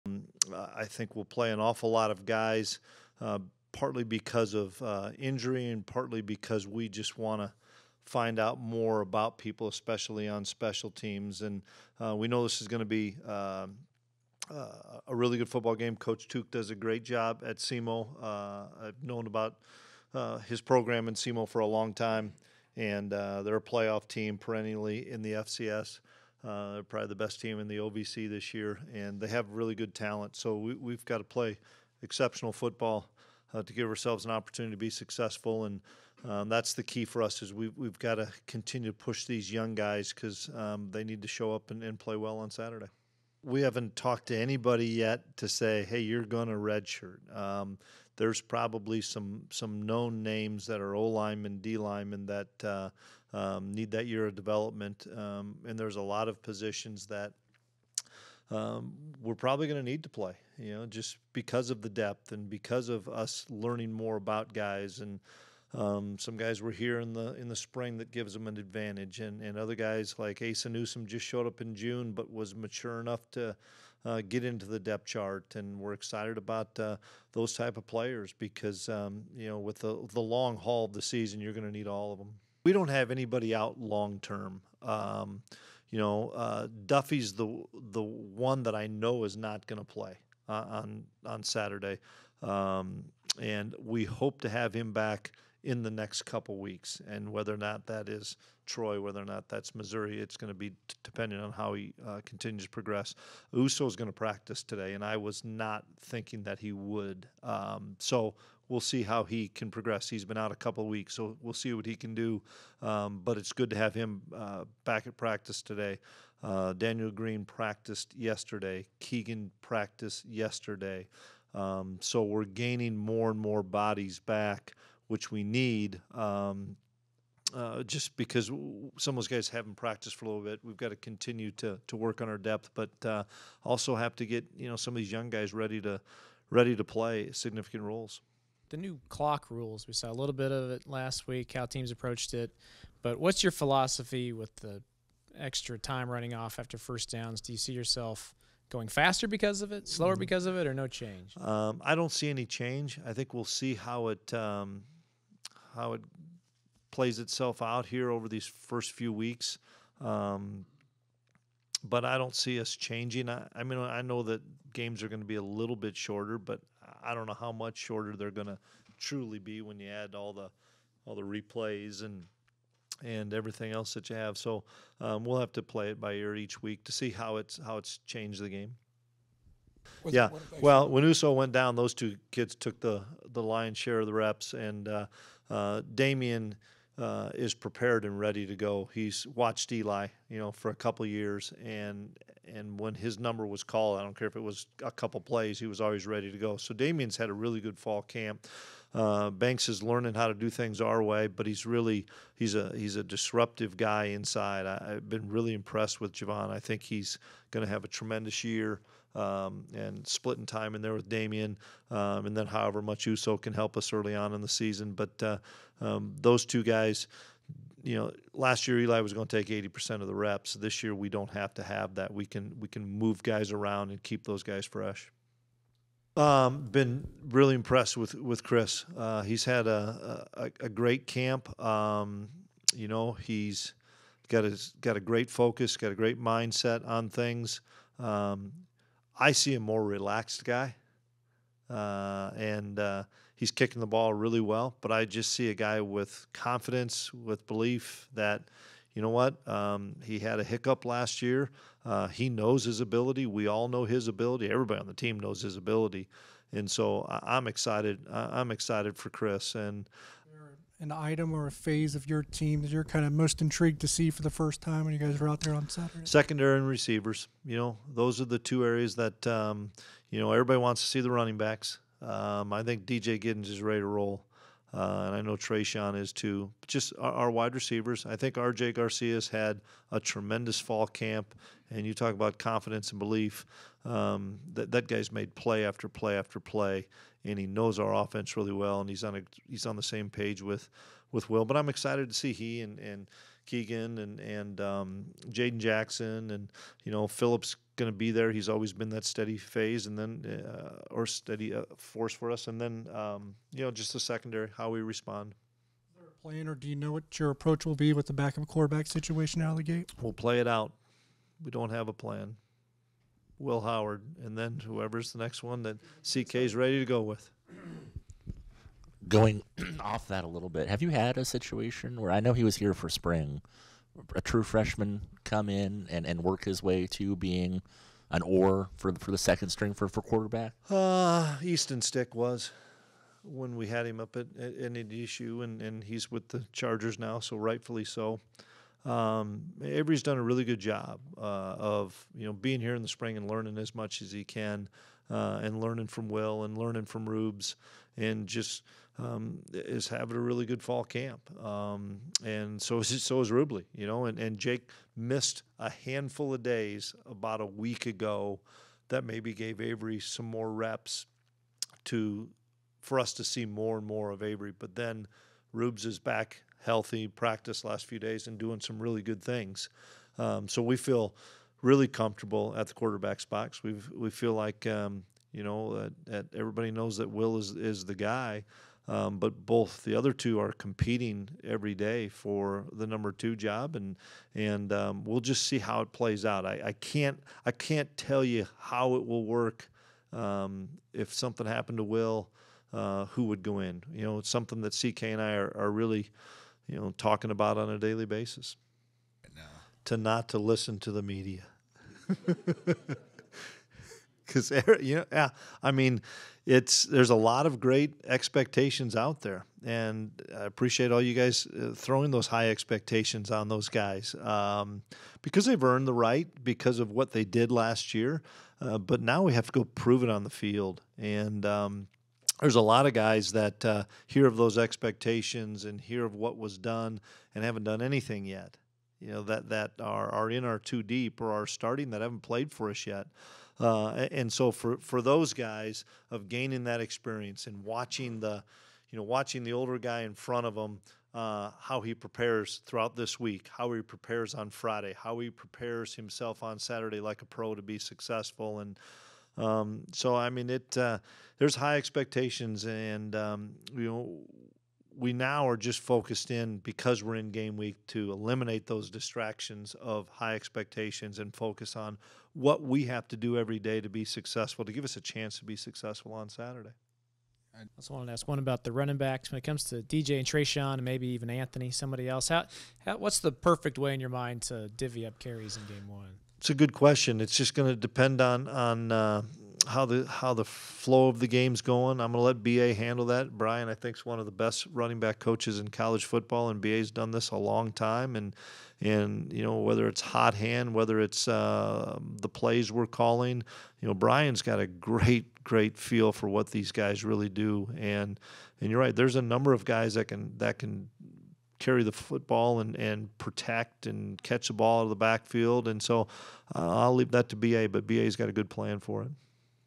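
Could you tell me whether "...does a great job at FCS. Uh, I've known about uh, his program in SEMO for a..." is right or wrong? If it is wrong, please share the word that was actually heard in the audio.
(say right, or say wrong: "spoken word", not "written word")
wrong: "SEMO", not "FCS".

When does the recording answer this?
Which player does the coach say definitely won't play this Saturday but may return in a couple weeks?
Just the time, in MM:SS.
01:26.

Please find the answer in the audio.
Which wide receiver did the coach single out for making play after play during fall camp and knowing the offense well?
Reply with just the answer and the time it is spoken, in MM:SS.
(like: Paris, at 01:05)
R.J. Garcia, at 04:38.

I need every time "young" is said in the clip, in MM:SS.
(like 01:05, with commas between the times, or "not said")
00:39, 02:15.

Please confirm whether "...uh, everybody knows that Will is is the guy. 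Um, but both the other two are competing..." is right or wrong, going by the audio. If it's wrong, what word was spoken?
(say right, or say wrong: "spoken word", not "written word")
right.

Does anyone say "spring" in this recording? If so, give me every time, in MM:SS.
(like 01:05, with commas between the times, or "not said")
01:07, 05:22, 05:42.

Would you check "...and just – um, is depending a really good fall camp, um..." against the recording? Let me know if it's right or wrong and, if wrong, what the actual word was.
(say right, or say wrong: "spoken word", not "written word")
wrong: "having", not "depending".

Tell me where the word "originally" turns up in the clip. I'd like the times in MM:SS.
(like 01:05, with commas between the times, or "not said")
not said.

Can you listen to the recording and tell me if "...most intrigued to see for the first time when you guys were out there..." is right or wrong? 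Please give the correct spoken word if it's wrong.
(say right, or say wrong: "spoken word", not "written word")
right.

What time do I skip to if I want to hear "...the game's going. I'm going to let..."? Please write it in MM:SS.
08:01.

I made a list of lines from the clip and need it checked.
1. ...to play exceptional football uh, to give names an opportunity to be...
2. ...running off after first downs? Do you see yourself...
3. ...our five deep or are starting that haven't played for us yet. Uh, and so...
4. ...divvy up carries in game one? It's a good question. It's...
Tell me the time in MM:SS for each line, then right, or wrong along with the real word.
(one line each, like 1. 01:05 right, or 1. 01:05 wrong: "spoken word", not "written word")
1. 00:31 wrong: "ourselves", not "names"
2. 02:26 right
3. 07:10 wrong: "two", not "five"
4. 07:54 right.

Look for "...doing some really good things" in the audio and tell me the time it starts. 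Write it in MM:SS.
06:08.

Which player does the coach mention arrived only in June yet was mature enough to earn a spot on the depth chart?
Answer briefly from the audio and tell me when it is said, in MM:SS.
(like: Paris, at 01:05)
Asa Newsom, at 01:10.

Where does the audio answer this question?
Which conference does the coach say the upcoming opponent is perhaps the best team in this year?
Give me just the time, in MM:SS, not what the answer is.
00:27.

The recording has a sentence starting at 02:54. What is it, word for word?
So um, we'll have to play it by ear each week to see how it's how it's changed the game.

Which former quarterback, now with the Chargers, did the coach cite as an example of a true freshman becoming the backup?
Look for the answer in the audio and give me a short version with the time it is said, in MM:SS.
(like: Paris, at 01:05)
Easton Stick, at 05:31.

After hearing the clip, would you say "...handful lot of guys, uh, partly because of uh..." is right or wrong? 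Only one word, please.
wrong.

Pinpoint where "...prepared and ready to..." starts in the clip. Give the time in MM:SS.
03:07.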